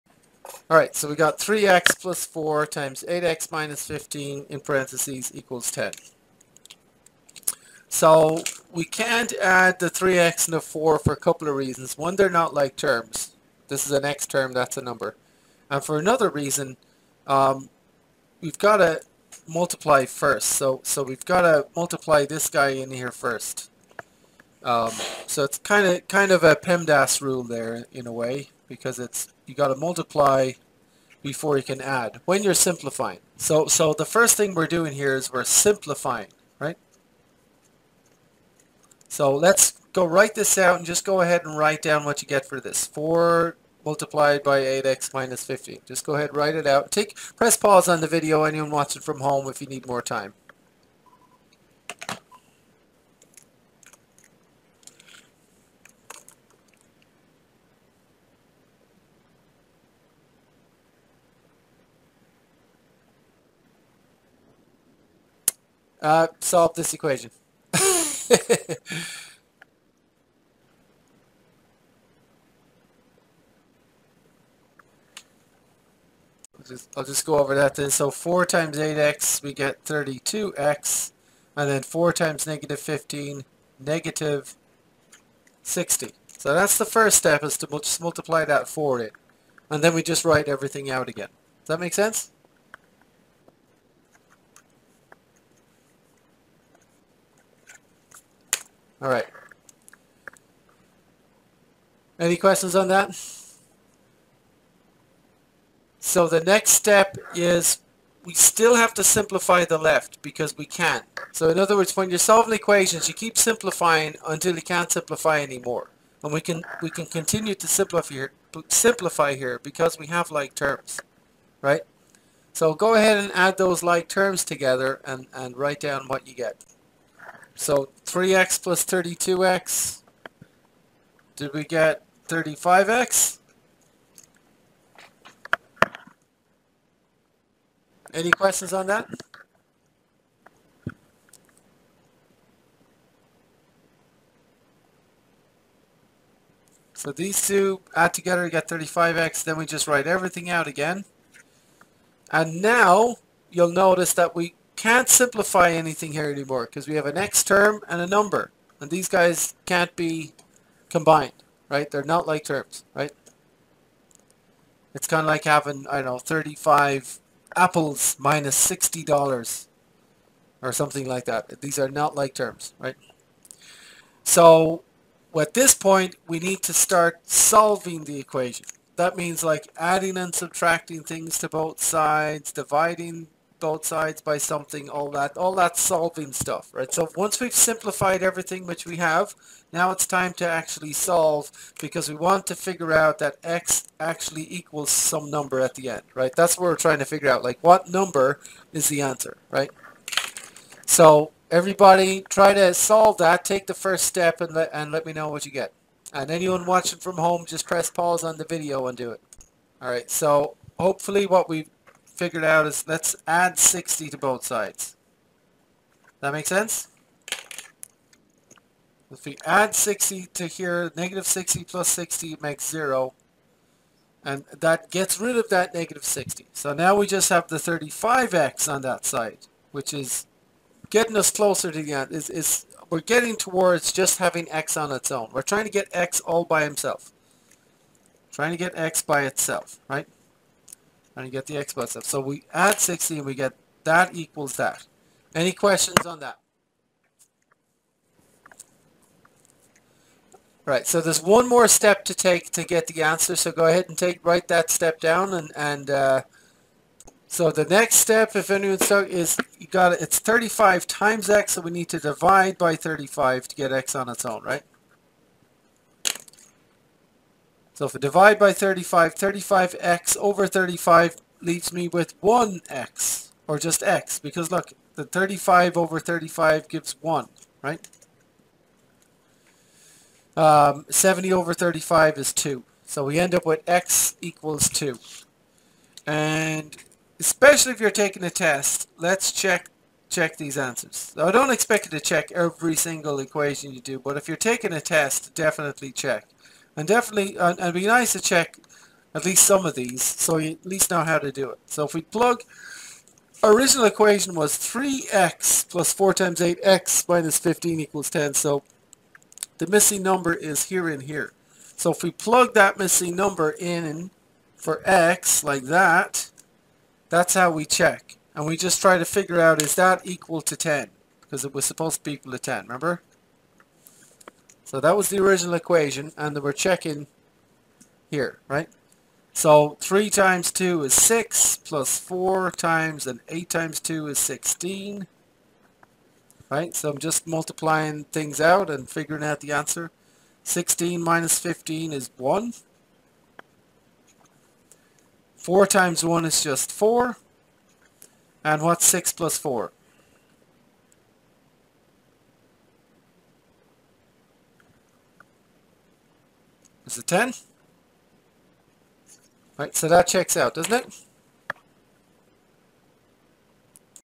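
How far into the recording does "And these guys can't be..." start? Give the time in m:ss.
2:38.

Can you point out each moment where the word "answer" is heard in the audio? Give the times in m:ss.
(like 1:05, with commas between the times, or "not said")
3:19, 4:13, 4:50, 5:39.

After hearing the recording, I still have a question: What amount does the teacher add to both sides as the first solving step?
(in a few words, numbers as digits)
60.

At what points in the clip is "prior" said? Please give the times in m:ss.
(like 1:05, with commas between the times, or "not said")
not said.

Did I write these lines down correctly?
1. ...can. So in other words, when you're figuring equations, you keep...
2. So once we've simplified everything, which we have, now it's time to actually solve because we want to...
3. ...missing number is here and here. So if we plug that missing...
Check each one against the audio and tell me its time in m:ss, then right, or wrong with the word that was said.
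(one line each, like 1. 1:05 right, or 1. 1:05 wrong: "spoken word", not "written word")
1. 1:50 wrong: "solving", not "figuring"
2. 3:06 right
3. 5:09 right.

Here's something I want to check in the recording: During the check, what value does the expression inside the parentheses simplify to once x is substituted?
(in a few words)
1.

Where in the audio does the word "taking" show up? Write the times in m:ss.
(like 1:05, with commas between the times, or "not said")
4:47, 4:54.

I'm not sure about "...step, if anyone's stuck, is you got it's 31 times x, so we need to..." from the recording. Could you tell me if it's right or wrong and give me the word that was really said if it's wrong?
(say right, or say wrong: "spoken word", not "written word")
wrong: "35", not "31".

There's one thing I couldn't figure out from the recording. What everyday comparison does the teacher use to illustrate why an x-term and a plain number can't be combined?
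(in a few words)
35 apples $60.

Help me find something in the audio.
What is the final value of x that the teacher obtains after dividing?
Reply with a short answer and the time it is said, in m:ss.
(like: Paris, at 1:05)
2, at 4:43.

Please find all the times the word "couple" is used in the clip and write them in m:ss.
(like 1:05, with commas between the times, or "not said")
0:11.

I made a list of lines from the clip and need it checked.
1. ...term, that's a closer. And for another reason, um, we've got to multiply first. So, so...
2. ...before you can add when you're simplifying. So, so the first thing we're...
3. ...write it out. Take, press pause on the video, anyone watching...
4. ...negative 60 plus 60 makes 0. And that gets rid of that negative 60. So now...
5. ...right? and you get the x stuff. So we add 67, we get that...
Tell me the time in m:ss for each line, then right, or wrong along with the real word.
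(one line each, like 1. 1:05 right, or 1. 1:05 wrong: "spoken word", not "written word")
1. 0:14 wrong: "number", not "closer"
2. 0:31 right
3. 0:46 right
4. 3:40 right
5. 3:59 wrong: "60", not "67".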